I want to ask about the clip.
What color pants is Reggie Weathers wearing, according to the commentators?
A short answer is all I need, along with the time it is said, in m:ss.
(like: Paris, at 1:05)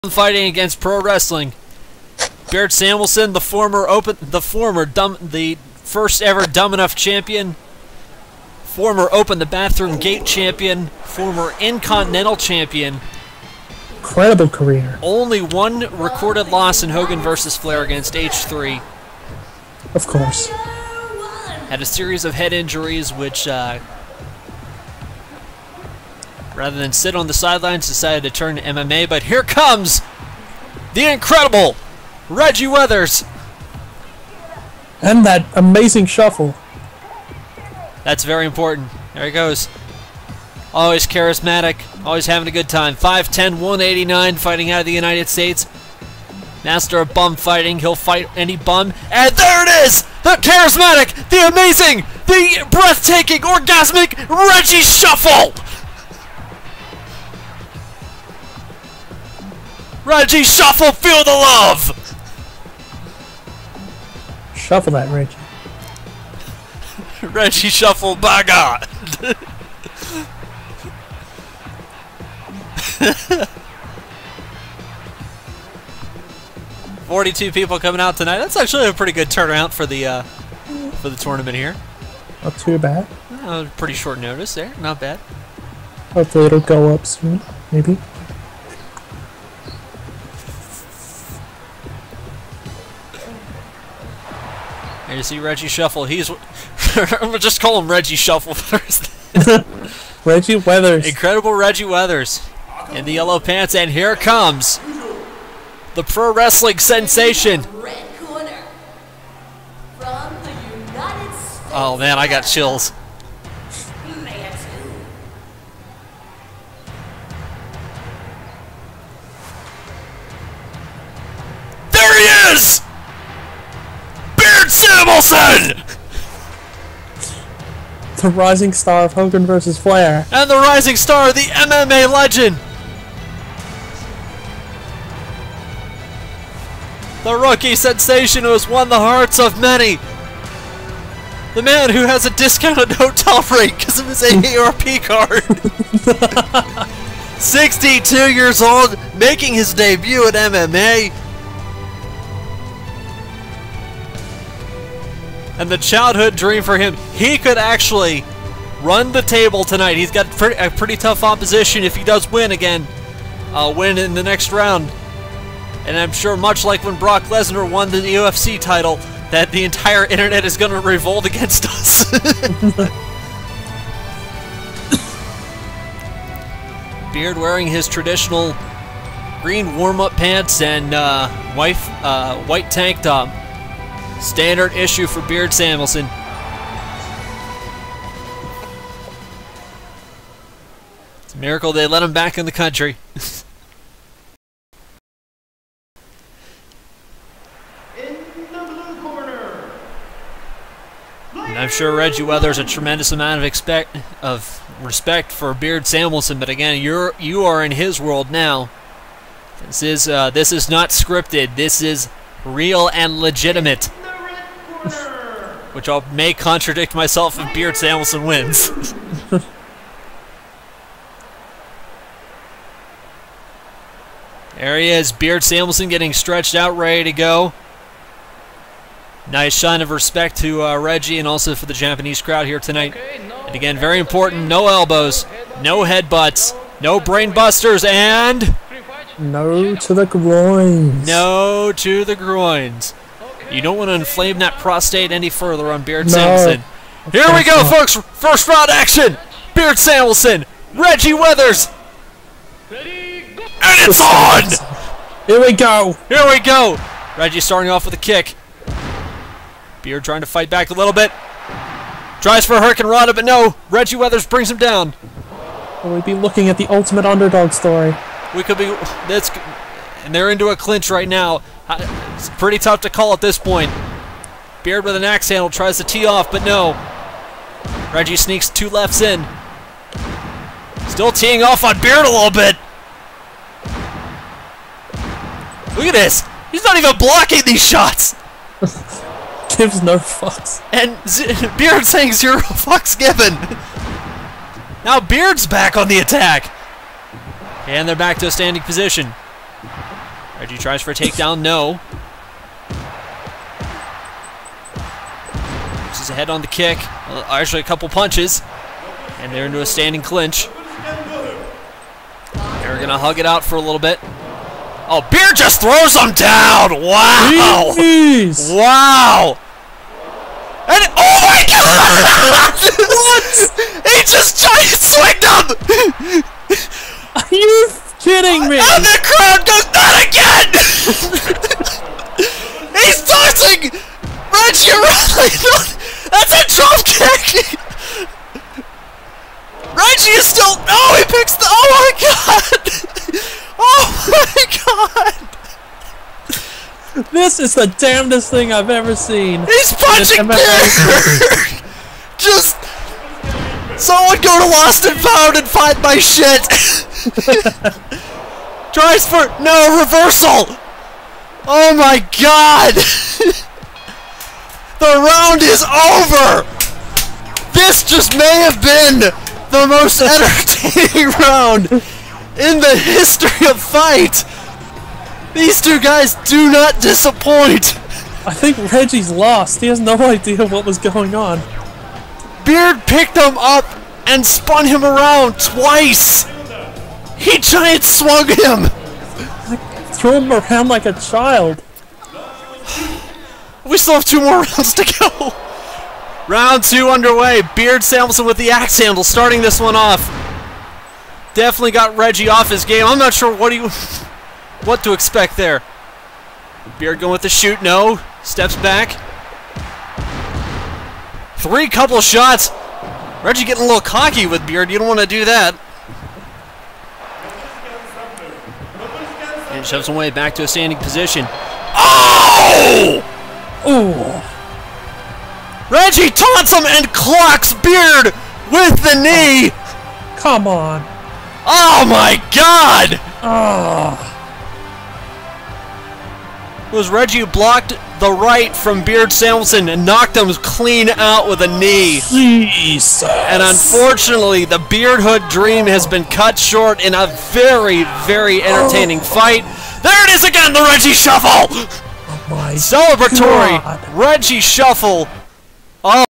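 Yellow, at 1:43.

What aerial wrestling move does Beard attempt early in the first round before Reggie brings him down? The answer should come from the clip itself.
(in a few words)
Hurricanrana.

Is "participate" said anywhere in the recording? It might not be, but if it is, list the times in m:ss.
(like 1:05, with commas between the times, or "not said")
not said.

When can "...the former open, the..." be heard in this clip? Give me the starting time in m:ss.
0:03.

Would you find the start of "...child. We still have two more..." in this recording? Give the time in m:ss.
6:30.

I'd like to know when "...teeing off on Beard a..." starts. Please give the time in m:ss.
4:41.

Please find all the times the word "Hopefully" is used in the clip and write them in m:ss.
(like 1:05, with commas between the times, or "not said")
1:26.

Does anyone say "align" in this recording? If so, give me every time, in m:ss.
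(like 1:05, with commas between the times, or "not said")
not said.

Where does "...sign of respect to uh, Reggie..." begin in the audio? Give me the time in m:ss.
3:49.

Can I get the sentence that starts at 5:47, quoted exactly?
This is the damnedest thing I've ever seen.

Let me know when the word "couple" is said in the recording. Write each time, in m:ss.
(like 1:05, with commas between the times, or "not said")
5:07, 6:51.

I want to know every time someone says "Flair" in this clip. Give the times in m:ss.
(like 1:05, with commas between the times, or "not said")
0:17, 2:09.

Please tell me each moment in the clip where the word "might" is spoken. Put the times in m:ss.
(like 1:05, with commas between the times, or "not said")
not said.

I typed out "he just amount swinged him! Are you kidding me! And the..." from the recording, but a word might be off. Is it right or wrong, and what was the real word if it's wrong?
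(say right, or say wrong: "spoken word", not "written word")
wrong: "giant", not "amount".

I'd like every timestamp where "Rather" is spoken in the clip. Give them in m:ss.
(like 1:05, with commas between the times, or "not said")
0:26.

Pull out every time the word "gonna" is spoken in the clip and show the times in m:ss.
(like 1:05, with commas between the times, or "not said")
1:37.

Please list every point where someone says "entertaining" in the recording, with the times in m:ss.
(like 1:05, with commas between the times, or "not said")
6:10, 7:28.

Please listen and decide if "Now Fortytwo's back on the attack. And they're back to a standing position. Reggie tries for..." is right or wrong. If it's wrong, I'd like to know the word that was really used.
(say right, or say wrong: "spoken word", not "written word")
wrong: "Beard", not "Fortytwo".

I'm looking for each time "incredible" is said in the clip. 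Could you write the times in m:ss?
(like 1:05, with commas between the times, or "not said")
0:13, 0:31, 1:41.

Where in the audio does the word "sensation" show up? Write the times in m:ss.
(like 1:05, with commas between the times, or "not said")
1:46, 2:17.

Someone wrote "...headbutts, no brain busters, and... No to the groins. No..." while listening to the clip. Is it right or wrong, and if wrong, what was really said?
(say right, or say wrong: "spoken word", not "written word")
right.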